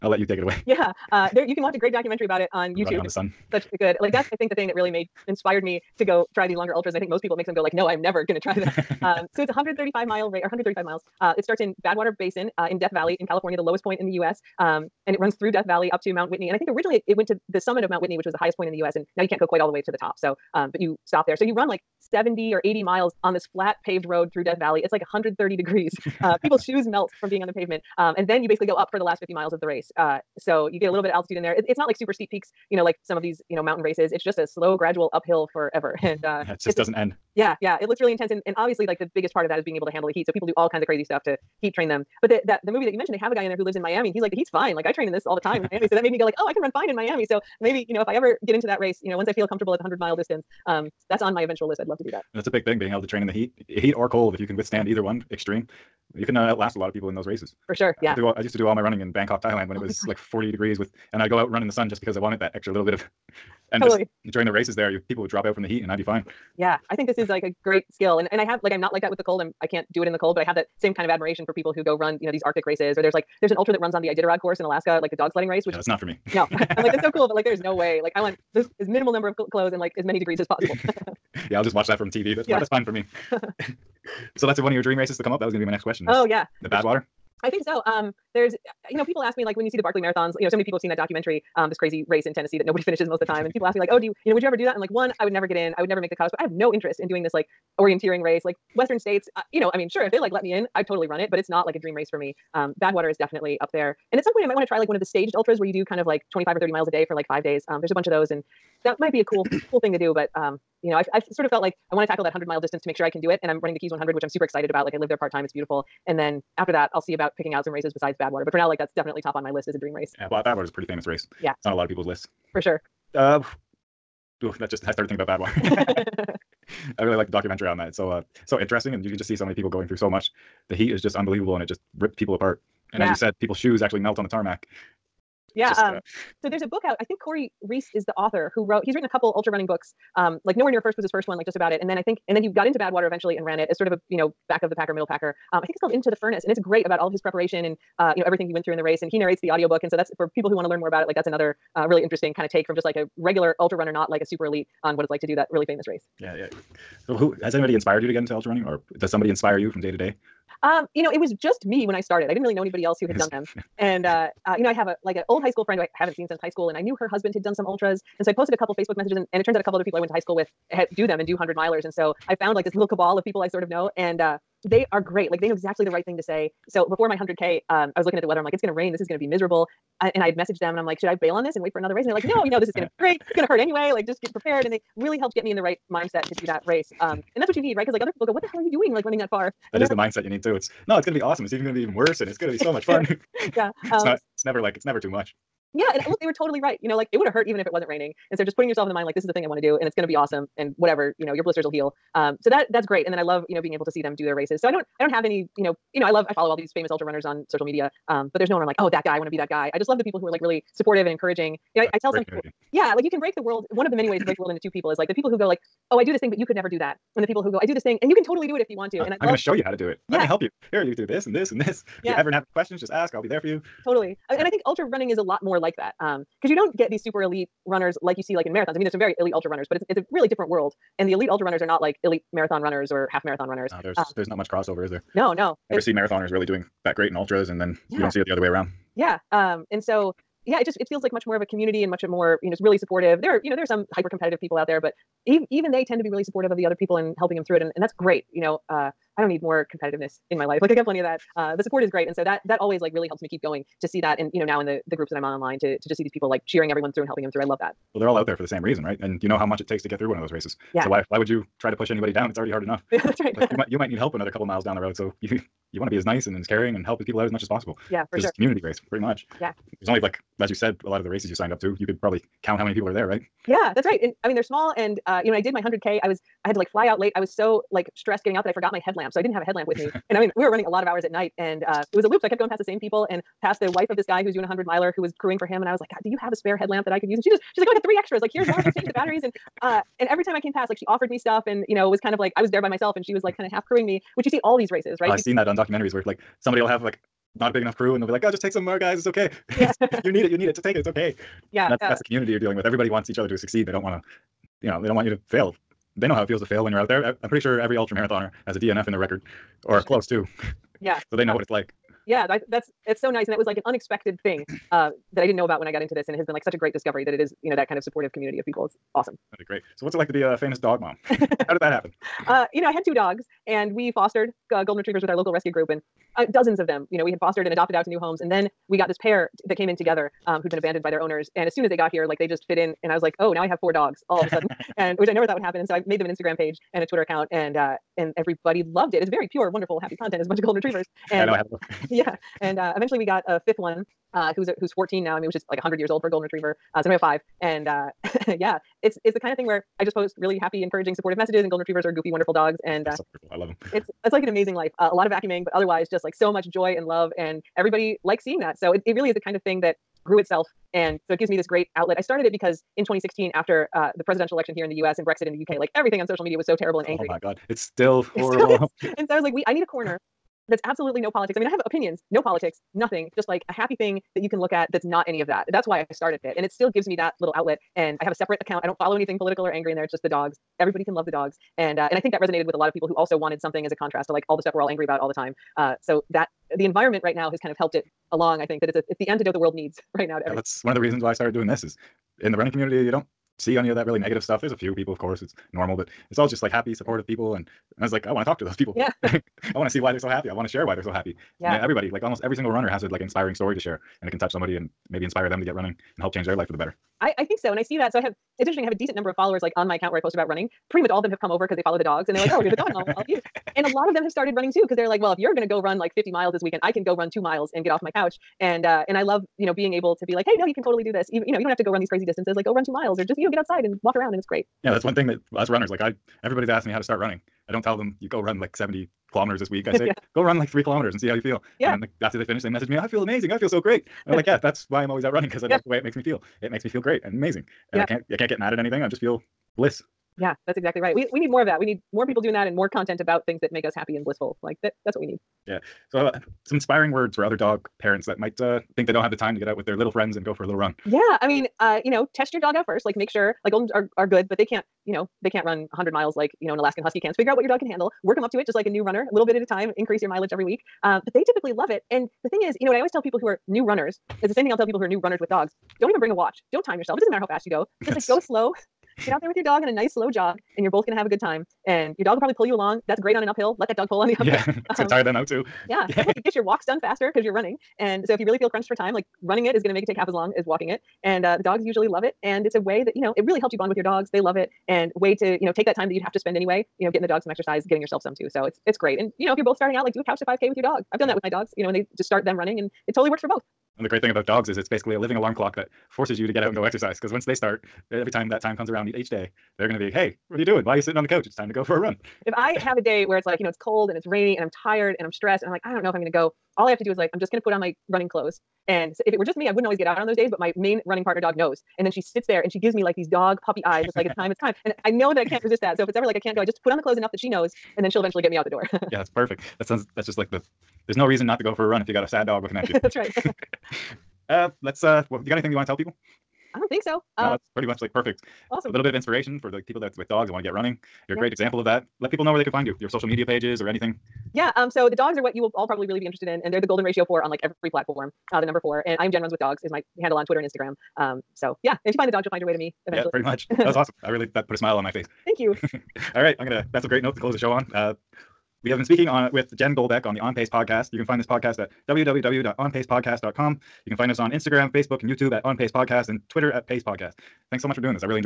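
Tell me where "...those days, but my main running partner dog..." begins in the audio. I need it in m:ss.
8:30.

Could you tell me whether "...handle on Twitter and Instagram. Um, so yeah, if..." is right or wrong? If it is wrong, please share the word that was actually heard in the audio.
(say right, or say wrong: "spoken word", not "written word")
right.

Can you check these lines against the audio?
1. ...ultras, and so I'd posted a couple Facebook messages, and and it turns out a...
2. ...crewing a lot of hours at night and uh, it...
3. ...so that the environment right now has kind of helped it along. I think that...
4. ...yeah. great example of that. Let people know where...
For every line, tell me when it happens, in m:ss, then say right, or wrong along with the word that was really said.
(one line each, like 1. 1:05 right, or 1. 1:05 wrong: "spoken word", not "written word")
1. 2:47 right
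2. 4:40 wrong: "running", not "crewing"
3. 6:25 right
4. 8:51 right.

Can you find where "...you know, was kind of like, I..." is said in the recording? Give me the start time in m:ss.
4:51.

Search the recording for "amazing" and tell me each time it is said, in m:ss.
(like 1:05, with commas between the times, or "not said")
5:54, 7:13, 7:17.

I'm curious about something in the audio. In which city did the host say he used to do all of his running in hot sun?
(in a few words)
Bangkok.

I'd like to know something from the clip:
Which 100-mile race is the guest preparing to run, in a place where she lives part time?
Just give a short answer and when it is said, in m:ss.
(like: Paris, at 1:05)
Keys 100, at 1:53.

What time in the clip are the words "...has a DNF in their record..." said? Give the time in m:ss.
5:08.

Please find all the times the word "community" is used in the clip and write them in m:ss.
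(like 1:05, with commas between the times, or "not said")
4:01, 4:28, 5:02, 5:18, 6:32.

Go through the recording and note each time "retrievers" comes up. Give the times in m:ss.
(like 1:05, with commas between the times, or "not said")
5:24, 5:40, 5:46, 5:51.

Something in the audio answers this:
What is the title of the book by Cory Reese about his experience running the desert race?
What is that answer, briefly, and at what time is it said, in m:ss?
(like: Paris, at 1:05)
Into the Furnace, at 2:25.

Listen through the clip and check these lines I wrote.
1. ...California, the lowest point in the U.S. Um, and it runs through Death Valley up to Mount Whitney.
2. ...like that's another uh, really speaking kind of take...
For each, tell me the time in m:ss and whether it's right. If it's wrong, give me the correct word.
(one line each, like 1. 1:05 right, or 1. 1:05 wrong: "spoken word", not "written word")
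1. 0:13 right
2. 2:31 wrong: "interesting", not "speaking".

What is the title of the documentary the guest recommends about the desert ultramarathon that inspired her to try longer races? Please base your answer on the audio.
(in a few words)
Running on the Sun.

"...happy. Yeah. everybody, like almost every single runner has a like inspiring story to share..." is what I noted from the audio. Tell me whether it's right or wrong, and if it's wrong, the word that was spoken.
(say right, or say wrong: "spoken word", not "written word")
right.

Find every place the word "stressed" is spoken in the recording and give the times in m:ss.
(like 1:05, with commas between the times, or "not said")
4:37, 8:25.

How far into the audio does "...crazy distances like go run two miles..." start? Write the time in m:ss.
7:01.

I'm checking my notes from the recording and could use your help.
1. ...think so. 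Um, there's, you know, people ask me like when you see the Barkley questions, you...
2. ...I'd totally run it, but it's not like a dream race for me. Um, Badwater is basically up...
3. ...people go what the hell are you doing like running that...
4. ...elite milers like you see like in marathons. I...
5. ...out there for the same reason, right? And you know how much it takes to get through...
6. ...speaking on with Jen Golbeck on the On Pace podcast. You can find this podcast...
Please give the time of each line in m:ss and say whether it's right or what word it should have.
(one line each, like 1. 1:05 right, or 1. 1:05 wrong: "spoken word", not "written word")
1. 1:27 wrong: "marathons", not "questions"
2. 1:40 wrong: "definitely", not "basically"
3. 3:08 right
4. 3:47 wrong: "runners", not "milers"
5. 4:18 right
6. 9:08 right.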